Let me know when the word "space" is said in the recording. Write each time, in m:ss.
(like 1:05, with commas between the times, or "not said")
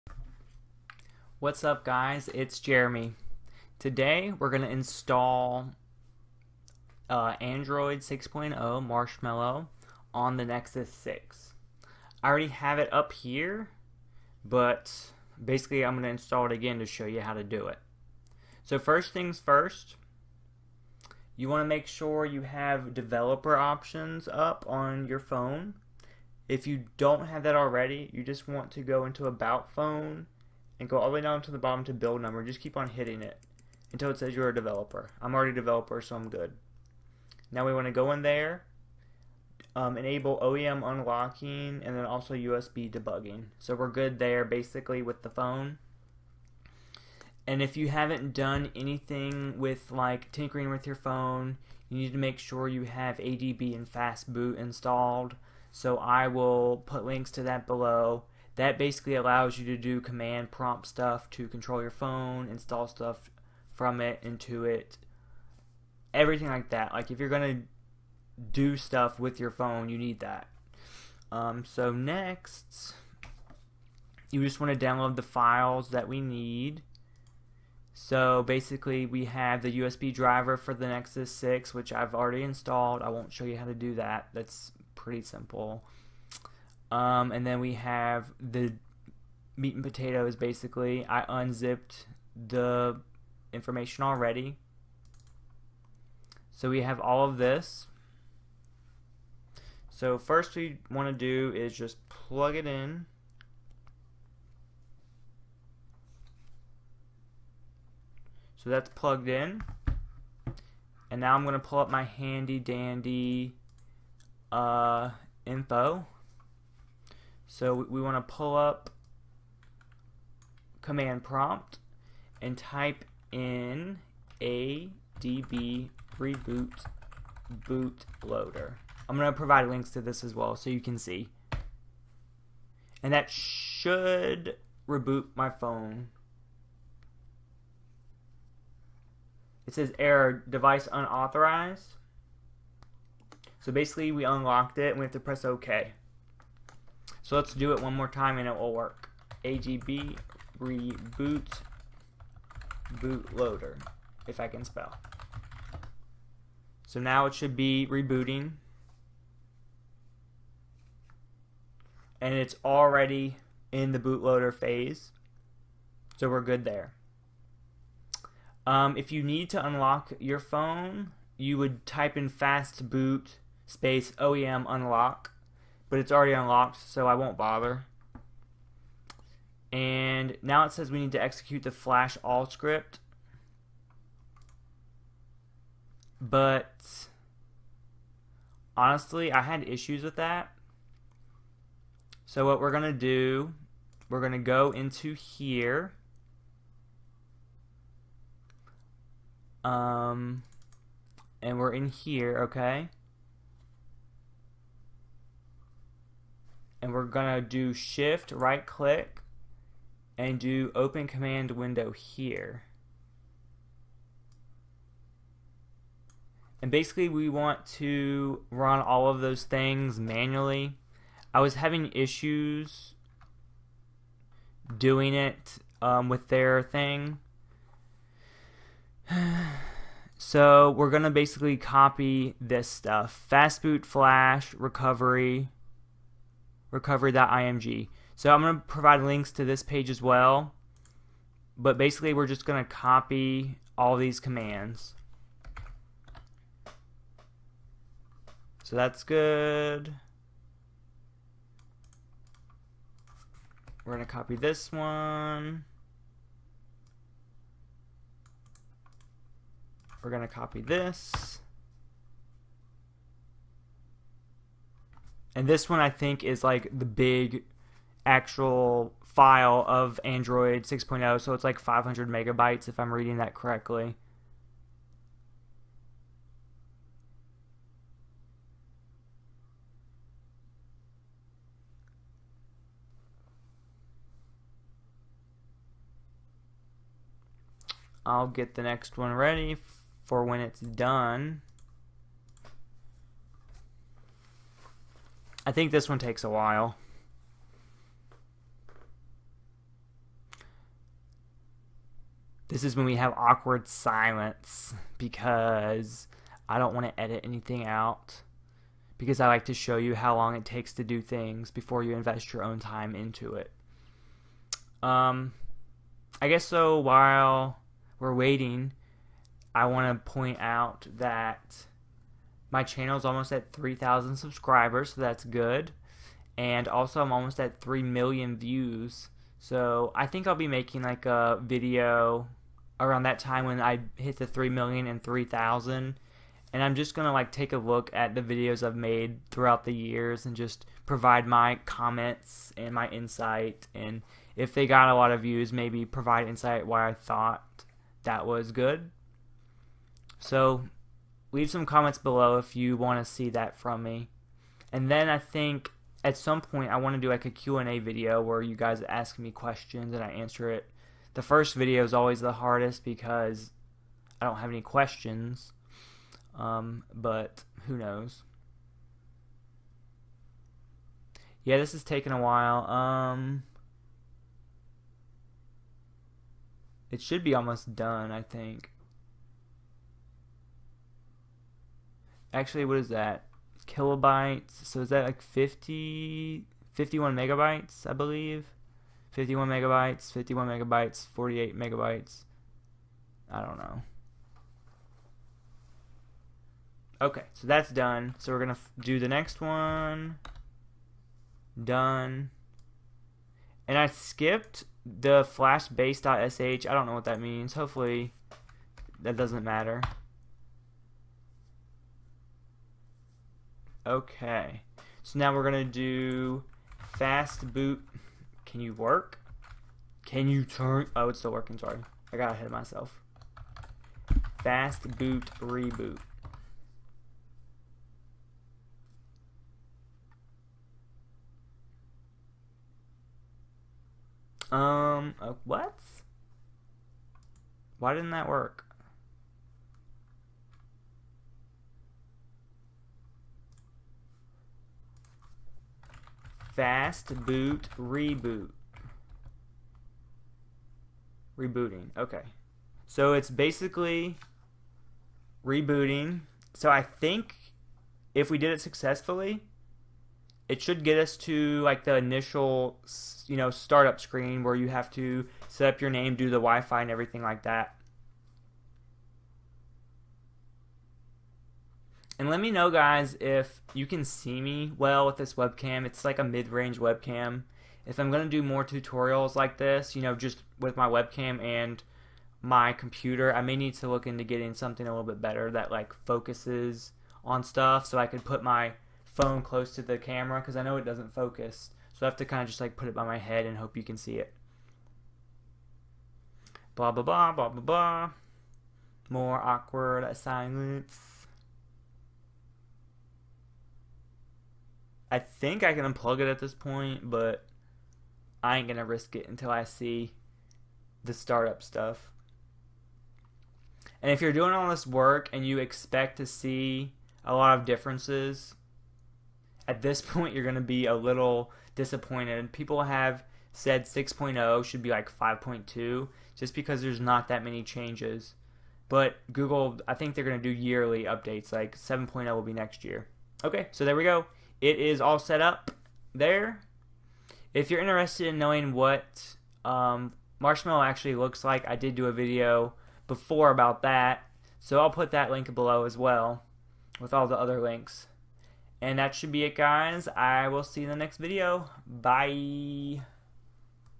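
2:53.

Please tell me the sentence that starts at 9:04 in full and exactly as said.
So I'll put that link below as well with all the other links.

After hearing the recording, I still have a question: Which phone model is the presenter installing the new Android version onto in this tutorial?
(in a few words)
Nexus 6.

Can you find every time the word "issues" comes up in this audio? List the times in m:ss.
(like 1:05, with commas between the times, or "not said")
3:09, 3:41.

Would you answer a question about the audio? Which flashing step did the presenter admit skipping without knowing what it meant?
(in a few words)
flash base.sh.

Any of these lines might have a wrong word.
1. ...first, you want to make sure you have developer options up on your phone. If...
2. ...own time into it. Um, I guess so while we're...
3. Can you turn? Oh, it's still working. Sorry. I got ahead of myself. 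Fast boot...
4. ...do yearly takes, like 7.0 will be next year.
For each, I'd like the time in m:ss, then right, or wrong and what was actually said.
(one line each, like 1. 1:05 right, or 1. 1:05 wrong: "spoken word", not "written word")
1. 0:19 right
2. 5:12 right
3. 7:00 right
4. 8:50 wrong: "updates", not "takes".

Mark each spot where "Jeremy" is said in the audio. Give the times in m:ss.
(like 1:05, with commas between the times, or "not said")
0:02.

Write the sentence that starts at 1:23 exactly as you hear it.
I won't show you how to do that.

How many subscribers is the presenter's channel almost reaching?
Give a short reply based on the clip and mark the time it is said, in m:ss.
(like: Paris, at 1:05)
3,000, at 5:23.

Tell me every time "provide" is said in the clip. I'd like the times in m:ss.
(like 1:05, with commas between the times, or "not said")
2:09, 3:58, 5:40, 5:45.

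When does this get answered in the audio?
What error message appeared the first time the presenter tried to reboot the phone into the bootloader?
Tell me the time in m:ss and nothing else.
2:19.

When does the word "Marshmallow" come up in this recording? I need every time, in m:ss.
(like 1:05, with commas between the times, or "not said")
0:08, 9:00.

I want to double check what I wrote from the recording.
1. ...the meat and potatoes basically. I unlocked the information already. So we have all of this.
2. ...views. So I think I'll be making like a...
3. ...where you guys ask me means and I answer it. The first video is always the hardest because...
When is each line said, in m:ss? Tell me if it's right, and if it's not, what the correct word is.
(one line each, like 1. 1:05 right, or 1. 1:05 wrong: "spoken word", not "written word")
1. 1:28 wrong: "unzipped", not "unlocked"
2. 5:28 right
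3. 5:58 wrong: "questions", not "means".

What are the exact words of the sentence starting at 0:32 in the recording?
Just keep on hitting it until it says you're a developer.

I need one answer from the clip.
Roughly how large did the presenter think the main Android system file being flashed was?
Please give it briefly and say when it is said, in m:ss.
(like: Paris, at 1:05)
500 megabytes, at 4:31.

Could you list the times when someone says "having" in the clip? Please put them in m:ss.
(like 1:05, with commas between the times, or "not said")
3:41.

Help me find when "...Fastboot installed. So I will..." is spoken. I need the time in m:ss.
0:53.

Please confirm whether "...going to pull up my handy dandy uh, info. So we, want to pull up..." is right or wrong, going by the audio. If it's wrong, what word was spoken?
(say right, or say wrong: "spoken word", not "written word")
right.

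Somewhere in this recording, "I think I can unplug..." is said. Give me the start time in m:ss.
8:25.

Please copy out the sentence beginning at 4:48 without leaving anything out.
I'll get the next one ready for when it's done.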